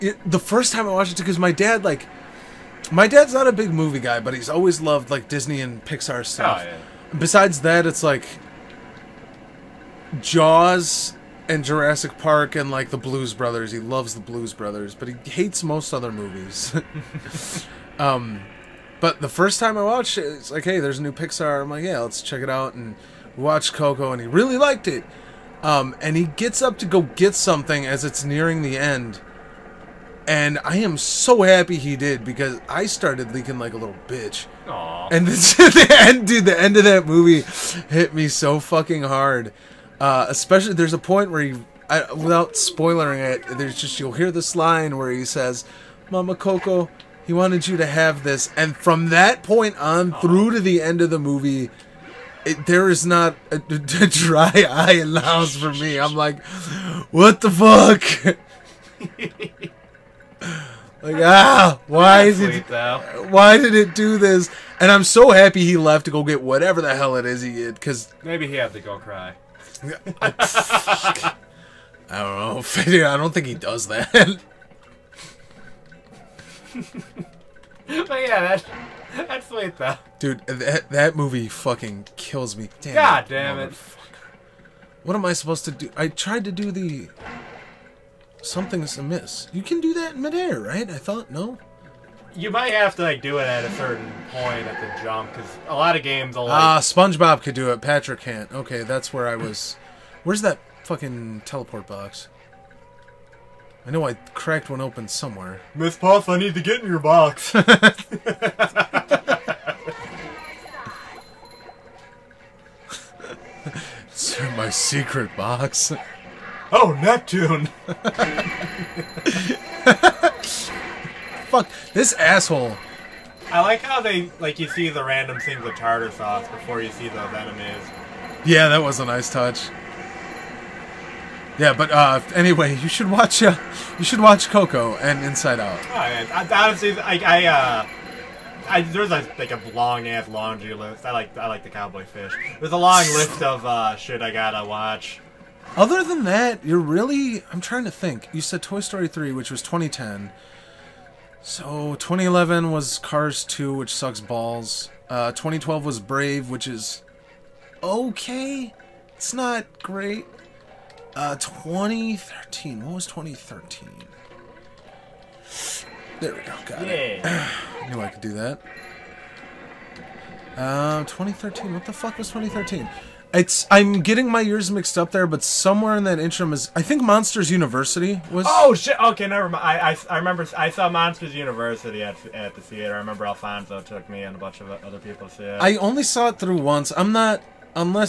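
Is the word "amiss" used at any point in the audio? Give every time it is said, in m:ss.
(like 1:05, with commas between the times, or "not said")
1:28.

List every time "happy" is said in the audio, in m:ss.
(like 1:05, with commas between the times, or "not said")
0:31, 1:05.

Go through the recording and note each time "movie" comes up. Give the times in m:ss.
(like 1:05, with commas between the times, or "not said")
0:03, 0:16, 0:37, 0:51, 1:21.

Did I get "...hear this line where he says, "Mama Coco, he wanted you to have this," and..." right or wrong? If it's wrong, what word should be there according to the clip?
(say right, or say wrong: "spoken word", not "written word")
right.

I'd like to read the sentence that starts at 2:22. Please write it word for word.
There's a long list of uh, shit I gotta watch.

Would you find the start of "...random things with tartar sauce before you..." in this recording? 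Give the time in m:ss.
2:05.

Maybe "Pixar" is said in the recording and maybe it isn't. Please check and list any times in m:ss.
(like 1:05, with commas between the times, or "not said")
0:05, 0:21.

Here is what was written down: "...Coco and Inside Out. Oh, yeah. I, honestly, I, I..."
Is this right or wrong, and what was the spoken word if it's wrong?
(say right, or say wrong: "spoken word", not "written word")
right.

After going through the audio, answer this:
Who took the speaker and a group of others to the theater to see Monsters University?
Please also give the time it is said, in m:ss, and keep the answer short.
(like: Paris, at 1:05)
Alfonso, at 3:03.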